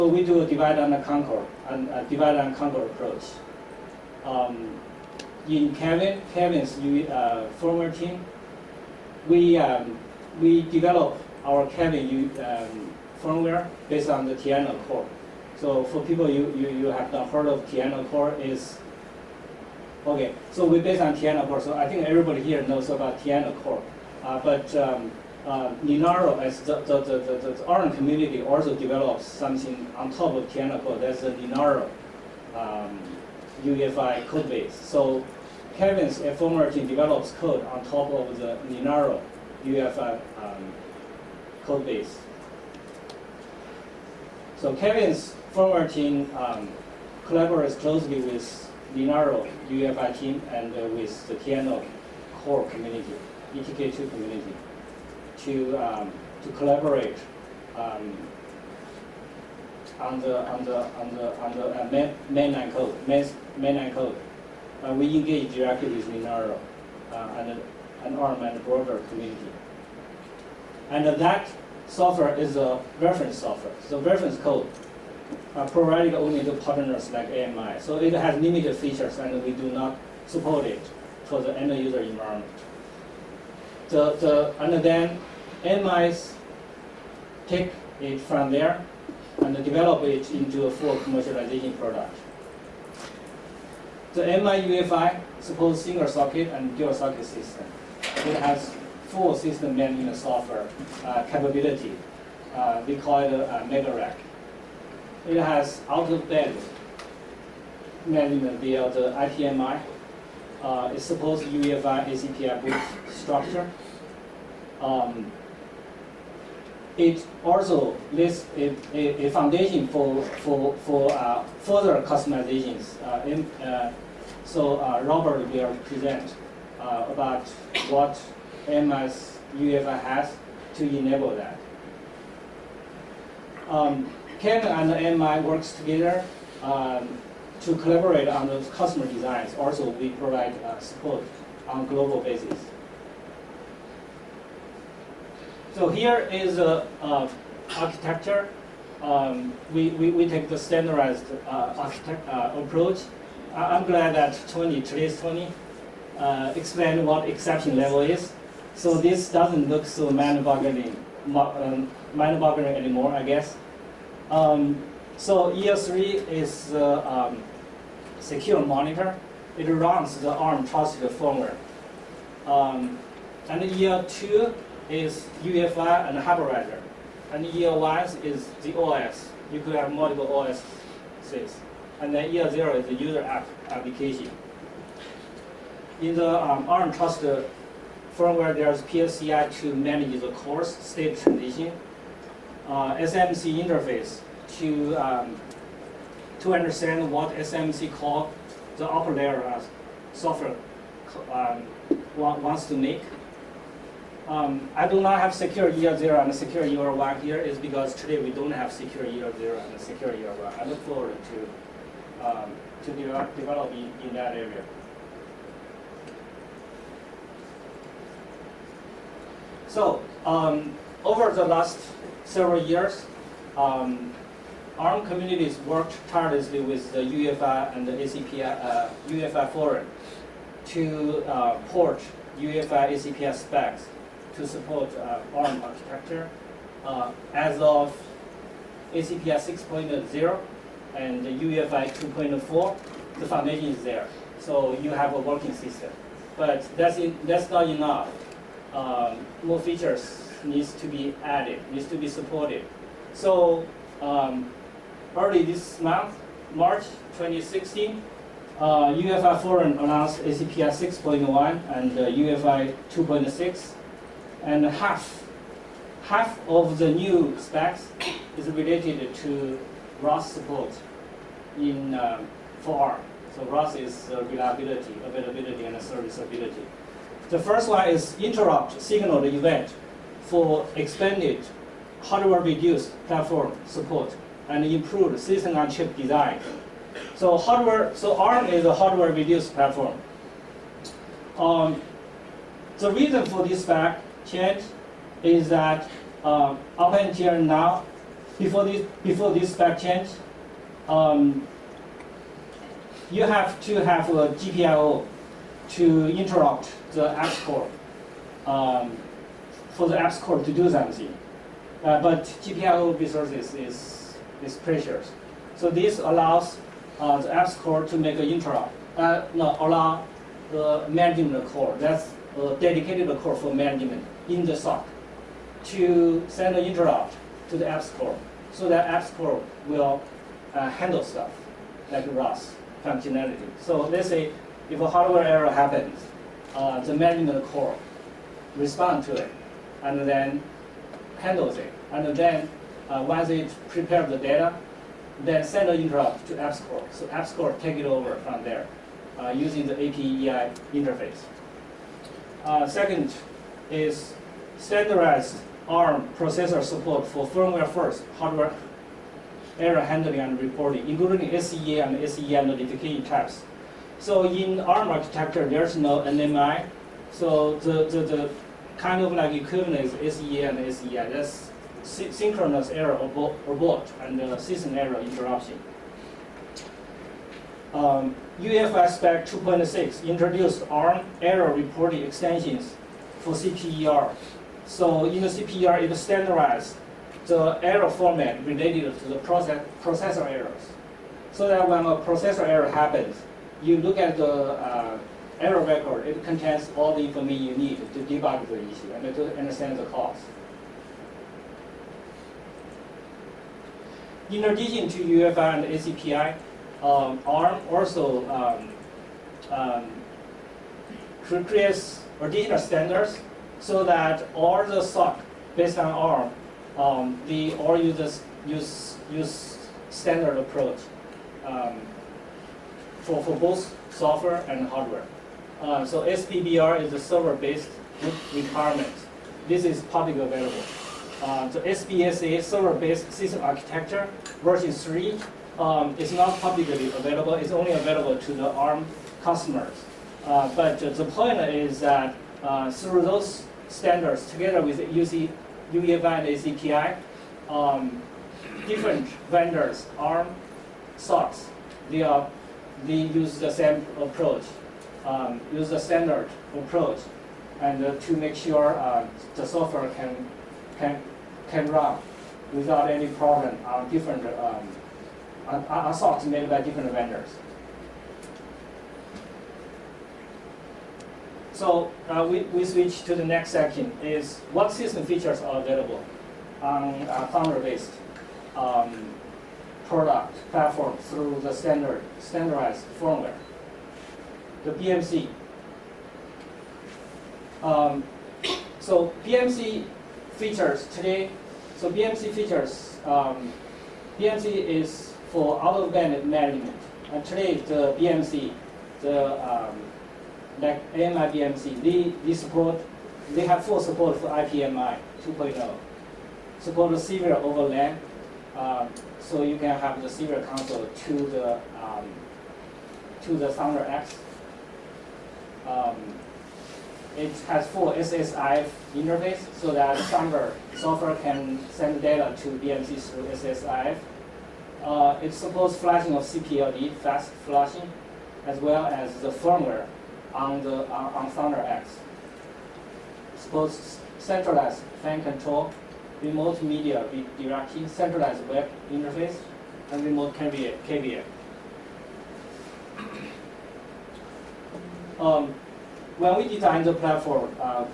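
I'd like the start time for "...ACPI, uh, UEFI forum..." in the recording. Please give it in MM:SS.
03:47.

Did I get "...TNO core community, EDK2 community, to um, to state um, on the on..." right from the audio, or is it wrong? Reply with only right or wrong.
wrong.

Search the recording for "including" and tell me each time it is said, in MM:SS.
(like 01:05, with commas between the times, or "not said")
06:00.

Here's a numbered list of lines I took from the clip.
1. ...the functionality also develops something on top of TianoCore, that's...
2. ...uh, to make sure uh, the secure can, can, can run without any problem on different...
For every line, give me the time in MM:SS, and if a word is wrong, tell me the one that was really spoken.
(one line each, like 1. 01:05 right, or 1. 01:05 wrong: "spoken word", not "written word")
1. 00:27 wrong: "community", not "functionality"
2. 07:37 wrong: "software", not "secure".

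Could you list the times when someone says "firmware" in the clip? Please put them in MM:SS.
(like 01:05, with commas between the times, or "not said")
00:07, 00:13, 00:45, 02:51, 03:08, 05:57, 08:02, 08:49.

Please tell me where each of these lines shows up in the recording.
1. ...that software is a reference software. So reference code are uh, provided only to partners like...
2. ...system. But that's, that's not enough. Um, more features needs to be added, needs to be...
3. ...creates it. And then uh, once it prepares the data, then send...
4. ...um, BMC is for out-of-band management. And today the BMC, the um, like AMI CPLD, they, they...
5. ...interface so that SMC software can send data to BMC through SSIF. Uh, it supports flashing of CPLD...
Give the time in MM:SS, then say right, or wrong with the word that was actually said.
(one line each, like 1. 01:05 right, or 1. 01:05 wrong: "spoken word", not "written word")
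1. 01:11 right
2. 04:05 right
3. 05:41 wrong: "handles", not "creates"
4. 08:13 wrong: "BMC", not "CPLD"
5. 08:38 wrong: "Thunder", not "SMC".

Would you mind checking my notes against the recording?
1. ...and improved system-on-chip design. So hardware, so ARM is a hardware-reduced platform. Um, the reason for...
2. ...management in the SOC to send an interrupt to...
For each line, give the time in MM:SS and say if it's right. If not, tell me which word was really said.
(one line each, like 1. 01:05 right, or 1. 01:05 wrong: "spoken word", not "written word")
1. 04:44 right
2. 05:23 right.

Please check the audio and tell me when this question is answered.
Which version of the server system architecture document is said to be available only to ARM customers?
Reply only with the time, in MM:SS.
07:14.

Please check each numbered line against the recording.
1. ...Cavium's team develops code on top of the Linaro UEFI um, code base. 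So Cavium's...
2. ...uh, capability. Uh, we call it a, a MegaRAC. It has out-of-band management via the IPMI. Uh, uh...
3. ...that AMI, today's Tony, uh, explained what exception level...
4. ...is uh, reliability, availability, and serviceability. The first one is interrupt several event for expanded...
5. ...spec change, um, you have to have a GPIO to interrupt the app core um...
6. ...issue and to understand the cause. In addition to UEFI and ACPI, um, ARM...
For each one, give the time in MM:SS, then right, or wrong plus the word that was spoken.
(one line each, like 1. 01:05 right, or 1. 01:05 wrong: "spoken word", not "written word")
1. 00:35 right
2. 01:41 right
3. 02:34 wrong: "Tony", not "AMI"
4. 04:33 wrong: "signal", not "several"
5. 04:59 right
6. 06:38 right.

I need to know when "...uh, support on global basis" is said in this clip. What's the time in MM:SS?
02:20.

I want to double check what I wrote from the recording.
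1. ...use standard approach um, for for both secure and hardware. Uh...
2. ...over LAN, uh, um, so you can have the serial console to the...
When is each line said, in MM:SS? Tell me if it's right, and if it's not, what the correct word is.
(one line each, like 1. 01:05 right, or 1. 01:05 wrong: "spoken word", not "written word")
1. 06:59 wrong: "software", not "secure"
2. 08:27 right.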